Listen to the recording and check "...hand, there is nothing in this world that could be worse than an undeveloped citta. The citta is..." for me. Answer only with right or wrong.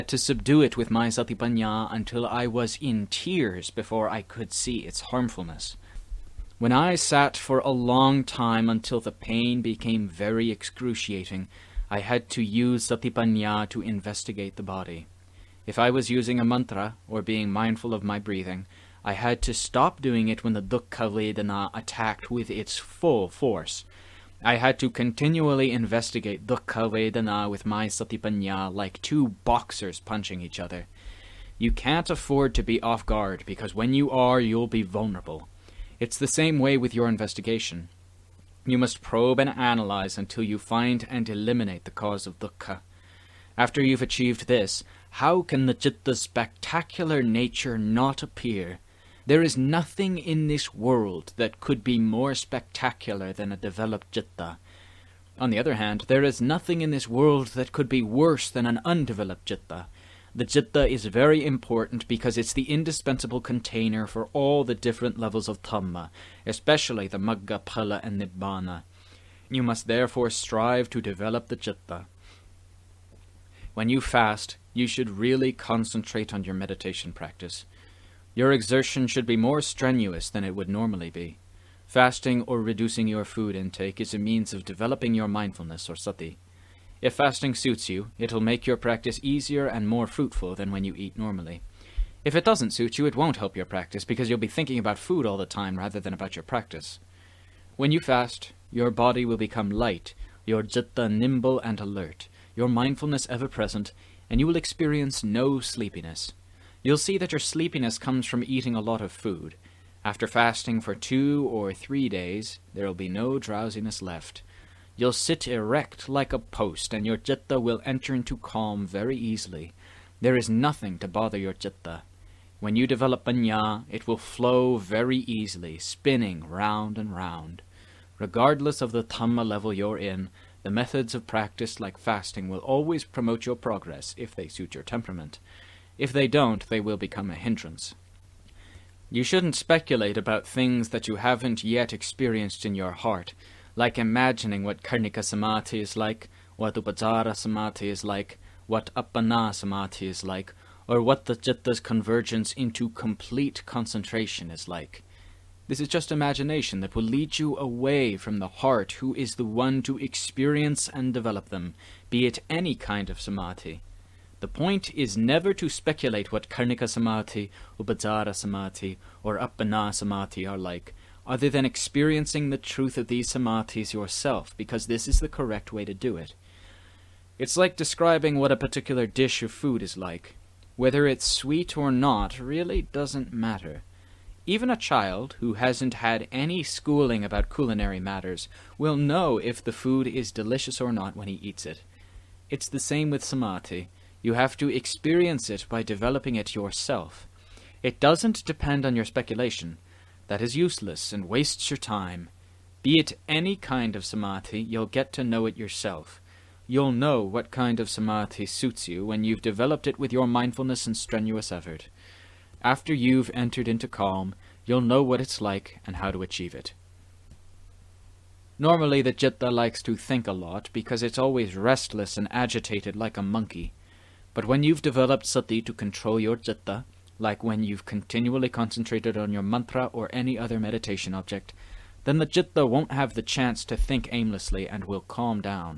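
right.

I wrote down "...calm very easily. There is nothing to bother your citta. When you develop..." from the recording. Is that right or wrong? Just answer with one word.
right.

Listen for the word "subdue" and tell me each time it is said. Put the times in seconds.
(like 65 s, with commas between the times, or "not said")
0 s.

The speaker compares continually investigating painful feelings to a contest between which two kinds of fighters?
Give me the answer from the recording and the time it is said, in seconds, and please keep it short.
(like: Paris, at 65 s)
Two boxers, at 29 s.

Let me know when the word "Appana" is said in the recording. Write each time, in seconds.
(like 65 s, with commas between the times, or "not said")
148 s, 169 s.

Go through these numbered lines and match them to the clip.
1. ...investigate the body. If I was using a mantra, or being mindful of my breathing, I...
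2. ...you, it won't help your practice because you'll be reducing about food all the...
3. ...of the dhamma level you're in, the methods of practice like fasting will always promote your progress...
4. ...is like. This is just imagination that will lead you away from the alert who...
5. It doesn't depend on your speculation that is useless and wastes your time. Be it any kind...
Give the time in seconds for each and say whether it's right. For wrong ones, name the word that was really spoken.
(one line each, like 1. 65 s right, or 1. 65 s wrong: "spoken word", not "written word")
1. 13 s right
2. 92 s wrong: "thinking", not "reducing"
3. 128 s right
4. 154 s wrong: "heart", not "alert"
5. 197 s right.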